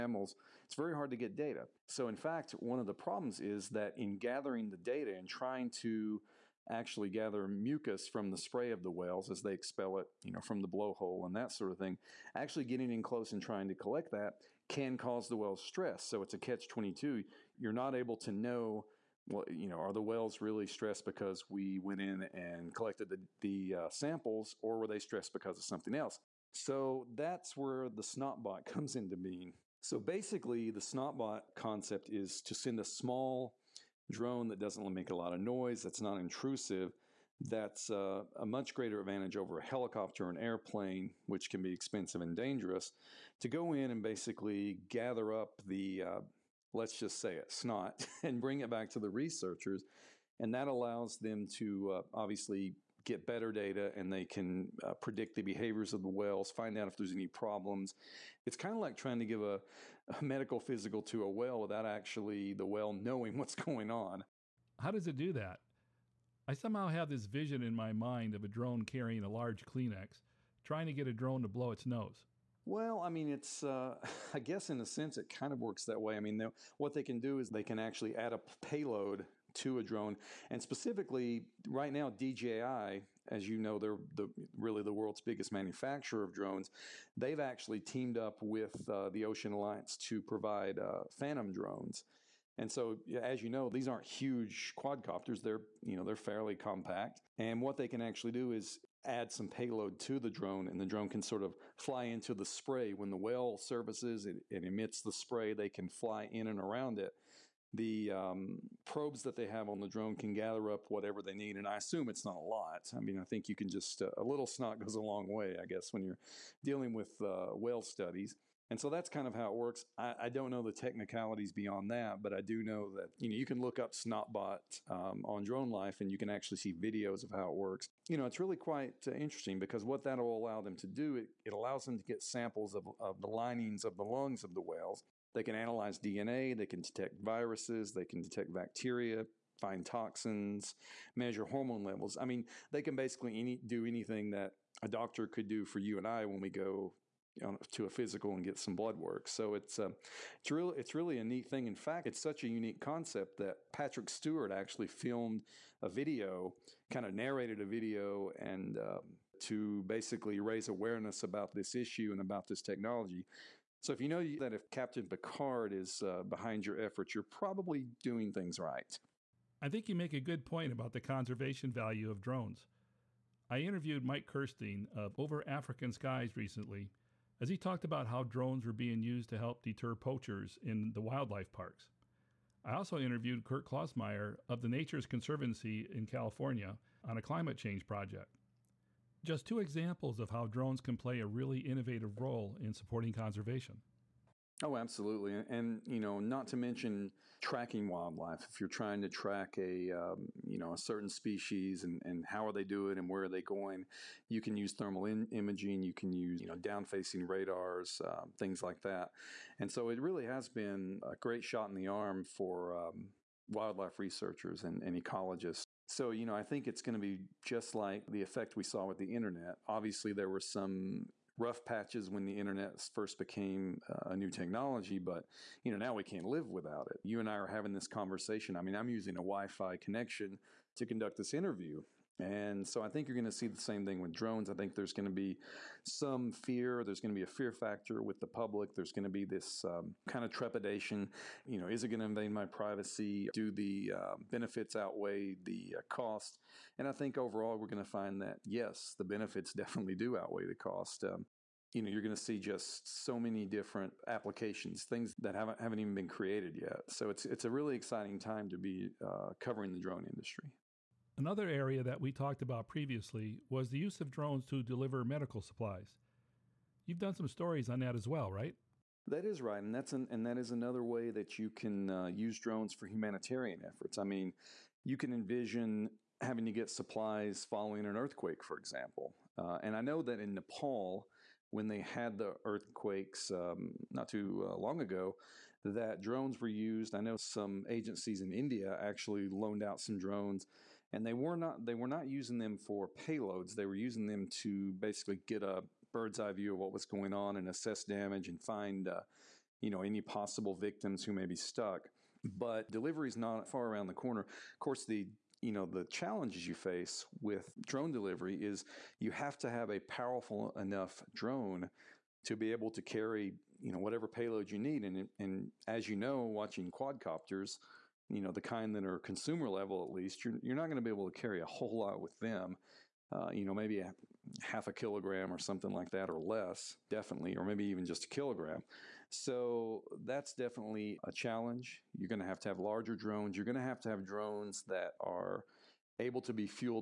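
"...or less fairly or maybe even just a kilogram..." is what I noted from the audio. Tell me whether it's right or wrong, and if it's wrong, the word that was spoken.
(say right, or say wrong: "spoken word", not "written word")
wrong: "definitely", not "fairly".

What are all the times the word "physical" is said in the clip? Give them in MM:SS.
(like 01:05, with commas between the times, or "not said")
01:00, 02:27.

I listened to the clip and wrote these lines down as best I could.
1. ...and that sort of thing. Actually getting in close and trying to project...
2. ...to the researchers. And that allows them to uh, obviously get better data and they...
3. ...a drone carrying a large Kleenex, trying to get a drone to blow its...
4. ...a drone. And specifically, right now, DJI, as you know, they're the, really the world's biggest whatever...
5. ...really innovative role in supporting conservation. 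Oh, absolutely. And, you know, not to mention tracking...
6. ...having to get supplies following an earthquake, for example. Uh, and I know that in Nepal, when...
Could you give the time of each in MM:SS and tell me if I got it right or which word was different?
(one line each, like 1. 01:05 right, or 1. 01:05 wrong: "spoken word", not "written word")
1. 00:11 wrong: "collect", not "project"
2. 00:48 right
3. 01:08 right
4. 01:19 wrong: "manufacturer", not "whatever"
5. 03:11 right
6. 04:36 right.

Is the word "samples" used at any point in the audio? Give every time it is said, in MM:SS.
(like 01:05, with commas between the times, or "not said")
00:23, 02:12.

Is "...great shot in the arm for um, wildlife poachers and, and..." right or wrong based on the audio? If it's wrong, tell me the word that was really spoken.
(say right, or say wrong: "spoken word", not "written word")
wrong: "researchers", not "poachers".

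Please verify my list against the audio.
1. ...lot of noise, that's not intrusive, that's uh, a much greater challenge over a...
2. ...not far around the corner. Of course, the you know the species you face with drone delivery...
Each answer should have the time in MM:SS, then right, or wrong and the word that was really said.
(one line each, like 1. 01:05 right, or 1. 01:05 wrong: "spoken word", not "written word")
1. 00:35 wrong: "advantage", not "challenge"
2. 05:03 wrong: "challenges", not "species".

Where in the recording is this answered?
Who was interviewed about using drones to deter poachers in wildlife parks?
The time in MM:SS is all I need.
02:54.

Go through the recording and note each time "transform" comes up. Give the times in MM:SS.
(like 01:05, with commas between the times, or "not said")
not said.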